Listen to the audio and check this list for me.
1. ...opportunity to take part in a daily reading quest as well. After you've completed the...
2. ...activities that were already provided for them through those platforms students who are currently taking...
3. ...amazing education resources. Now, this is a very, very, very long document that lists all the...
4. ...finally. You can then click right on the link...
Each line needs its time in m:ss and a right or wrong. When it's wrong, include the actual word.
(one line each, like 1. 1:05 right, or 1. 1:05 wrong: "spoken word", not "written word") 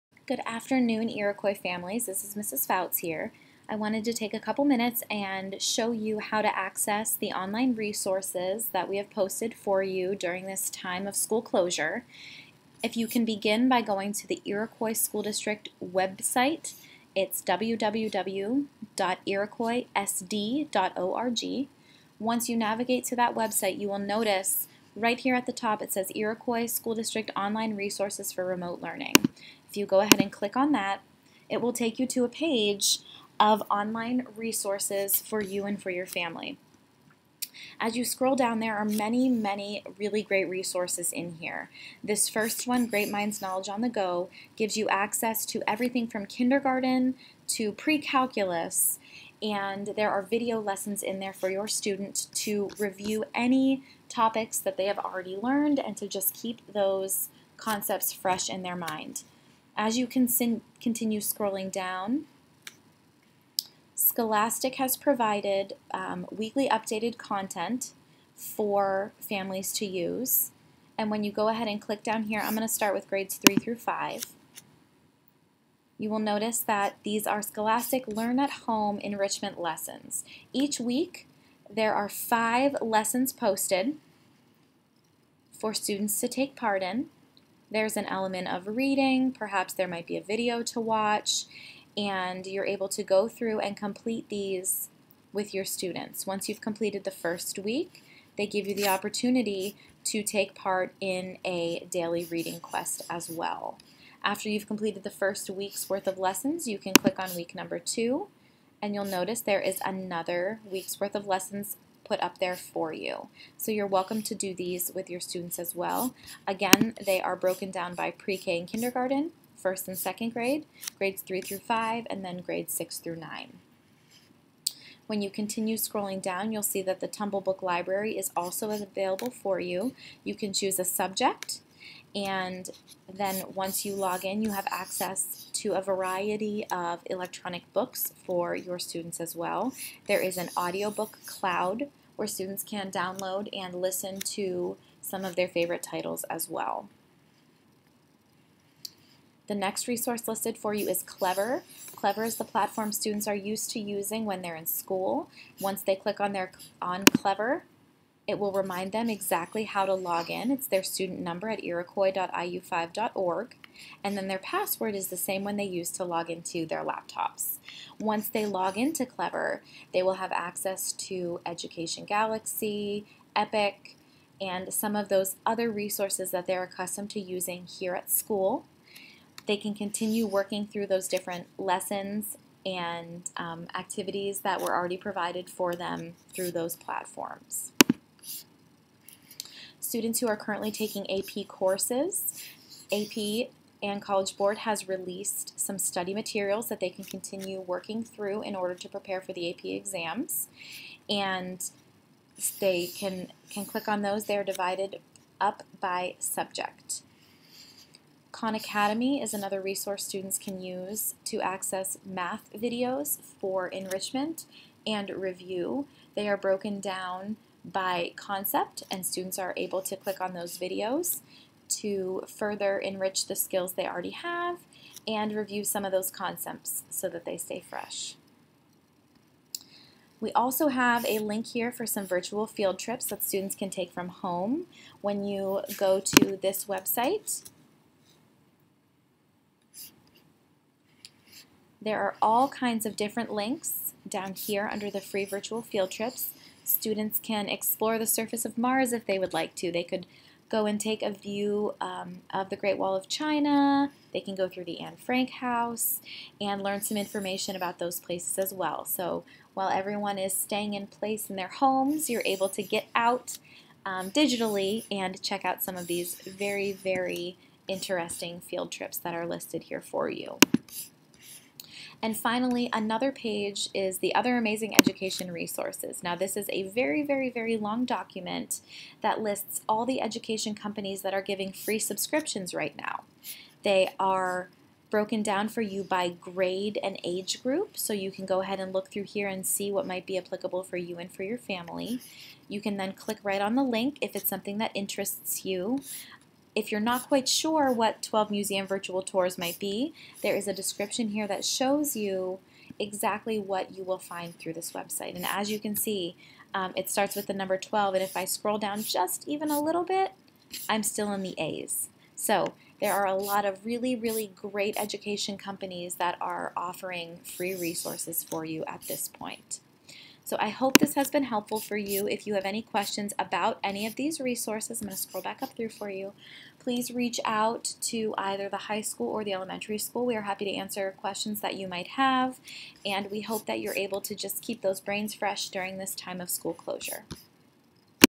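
1. 1:38 right
2. 3:03 right
3. 4:34 right
4. 4:51 wrong: "family", not "finally".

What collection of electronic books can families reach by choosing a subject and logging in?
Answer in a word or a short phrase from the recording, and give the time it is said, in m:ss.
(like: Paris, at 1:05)
Tumble Book Library, at 2:07.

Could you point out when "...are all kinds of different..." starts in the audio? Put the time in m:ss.
4:01.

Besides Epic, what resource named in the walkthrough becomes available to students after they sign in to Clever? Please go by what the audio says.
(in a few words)
Education Galaxy.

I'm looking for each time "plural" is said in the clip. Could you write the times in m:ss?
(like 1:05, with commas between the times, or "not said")
not said.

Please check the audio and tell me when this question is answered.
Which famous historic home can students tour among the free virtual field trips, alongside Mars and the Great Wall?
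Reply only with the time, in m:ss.
4:14.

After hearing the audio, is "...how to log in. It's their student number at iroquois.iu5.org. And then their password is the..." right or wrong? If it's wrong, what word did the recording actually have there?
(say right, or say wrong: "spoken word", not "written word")
right.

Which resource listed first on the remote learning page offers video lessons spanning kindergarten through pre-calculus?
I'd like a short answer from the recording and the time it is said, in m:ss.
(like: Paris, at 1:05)
Great Minds Knowledge on the Go, at 0:42.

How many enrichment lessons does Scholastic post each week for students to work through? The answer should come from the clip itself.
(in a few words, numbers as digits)
5.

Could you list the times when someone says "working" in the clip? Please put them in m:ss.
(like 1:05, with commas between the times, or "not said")
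3:00, 3:17.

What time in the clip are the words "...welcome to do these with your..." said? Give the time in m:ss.
1:53.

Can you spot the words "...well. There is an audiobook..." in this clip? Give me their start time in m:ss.
2:19.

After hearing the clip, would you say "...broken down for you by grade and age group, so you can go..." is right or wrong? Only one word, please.
right.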